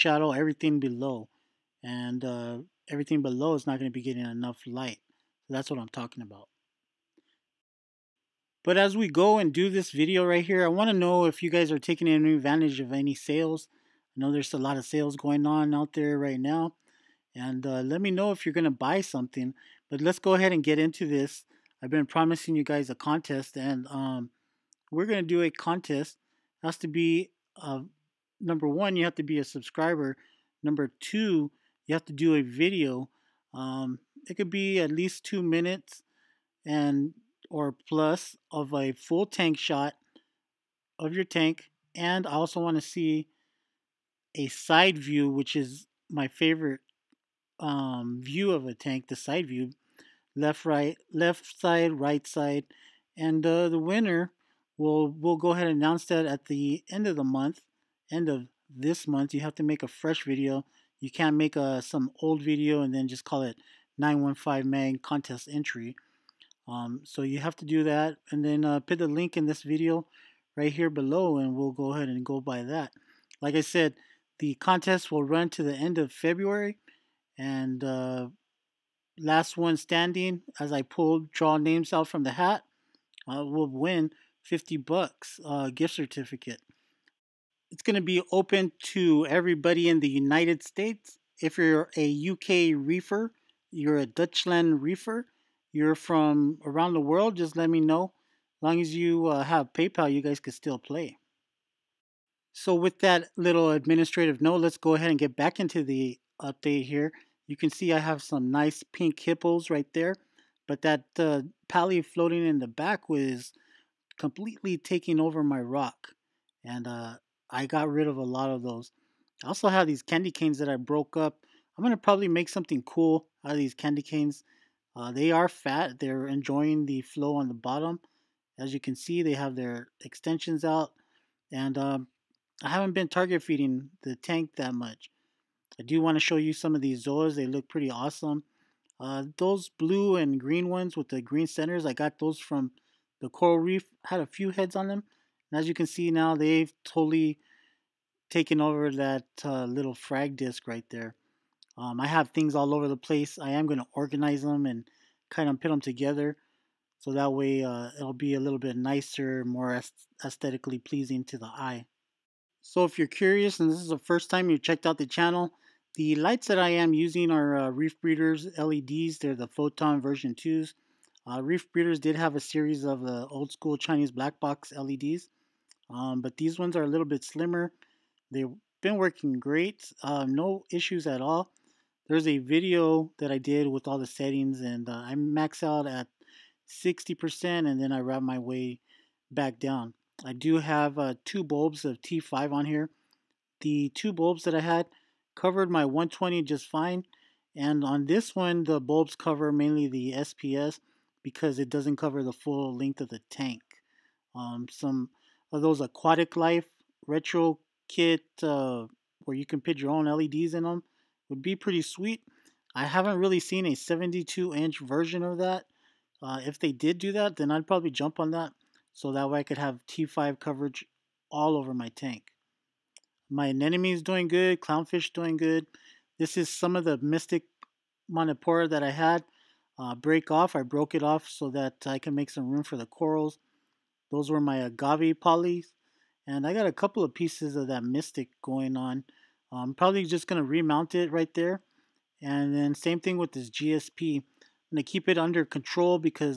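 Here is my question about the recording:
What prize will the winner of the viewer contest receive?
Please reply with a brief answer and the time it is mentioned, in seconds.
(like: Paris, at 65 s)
$50 gift certificate, at 84 s.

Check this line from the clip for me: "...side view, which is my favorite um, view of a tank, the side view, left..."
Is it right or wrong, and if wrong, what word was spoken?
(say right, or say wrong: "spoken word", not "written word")
right.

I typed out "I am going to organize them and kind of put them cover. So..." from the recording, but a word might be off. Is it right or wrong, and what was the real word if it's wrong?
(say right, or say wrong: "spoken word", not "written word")
wrong: "together", not "cover".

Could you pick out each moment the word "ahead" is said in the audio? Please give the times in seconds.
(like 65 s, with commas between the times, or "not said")
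20 s, 55 s, 71 s, 104 s.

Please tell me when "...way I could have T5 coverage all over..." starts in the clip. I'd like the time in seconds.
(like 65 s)
219 s.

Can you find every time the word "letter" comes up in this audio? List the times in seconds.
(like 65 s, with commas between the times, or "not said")
not said.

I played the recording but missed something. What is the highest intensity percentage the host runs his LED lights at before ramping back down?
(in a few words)
60%.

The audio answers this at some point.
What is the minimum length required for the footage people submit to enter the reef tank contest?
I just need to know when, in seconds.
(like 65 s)
34 s.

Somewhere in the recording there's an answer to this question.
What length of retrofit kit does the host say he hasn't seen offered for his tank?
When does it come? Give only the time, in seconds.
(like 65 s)
213 s.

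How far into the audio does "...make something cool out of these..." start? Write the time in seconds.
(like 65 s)
122 s.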